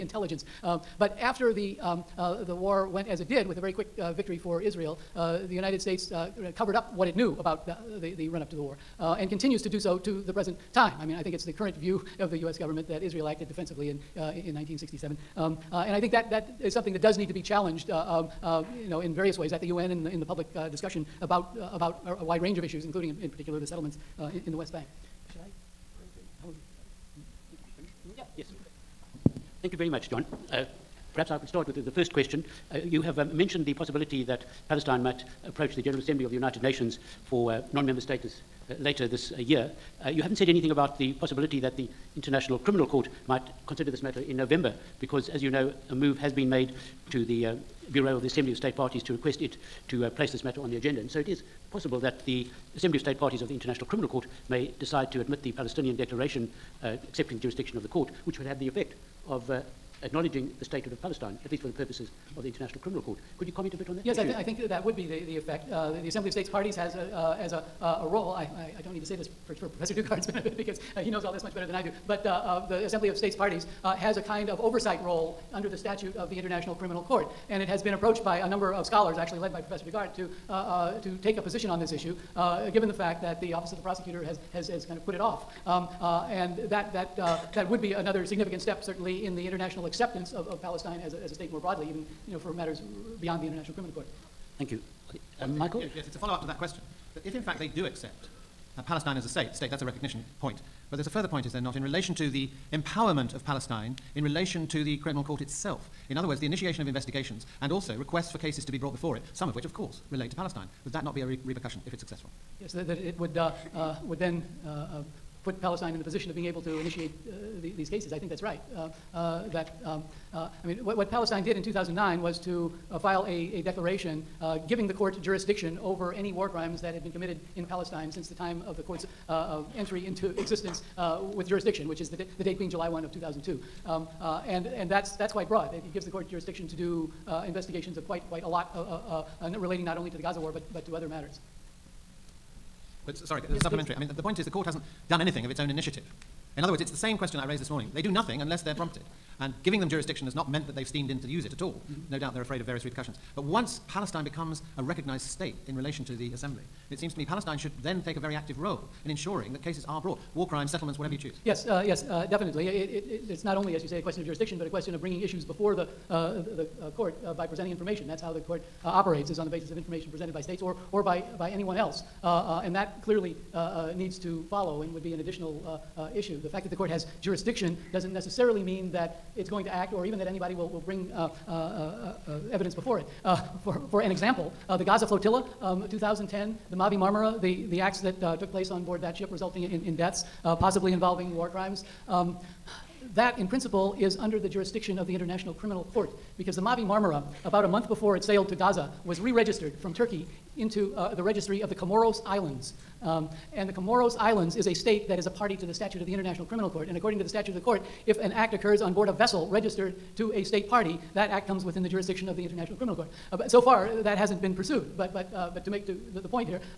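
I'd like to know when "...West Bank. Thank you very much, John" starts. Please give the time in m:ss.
0:24.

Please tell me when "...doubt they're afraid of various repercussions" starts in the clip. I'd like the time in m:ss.
2:32.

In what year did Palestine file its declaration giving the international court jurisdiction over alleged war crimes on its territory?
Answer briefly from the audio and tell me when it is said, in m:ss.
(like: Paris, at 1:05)
2009, at 2:01.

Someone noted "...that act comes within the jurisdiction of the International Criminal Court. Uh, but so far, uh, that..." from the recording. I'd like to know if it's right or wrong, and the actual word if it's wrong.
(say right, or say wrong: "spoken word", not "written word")
right.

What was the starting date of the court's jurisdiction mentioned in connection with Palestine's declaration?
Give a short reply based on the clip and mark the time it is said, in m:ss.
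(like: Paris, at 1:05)
July 1, 2002, at 2:12.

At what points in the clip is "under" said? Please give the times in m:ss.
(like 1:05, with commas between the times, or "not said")
1:15, 3:14.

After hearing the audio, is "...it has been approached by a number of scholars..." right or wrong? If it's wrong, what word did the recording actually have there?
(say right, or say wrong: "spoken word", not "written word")
right.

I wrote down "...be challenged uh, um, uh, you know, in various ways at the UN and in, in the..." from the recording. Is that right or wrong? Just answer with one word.
right.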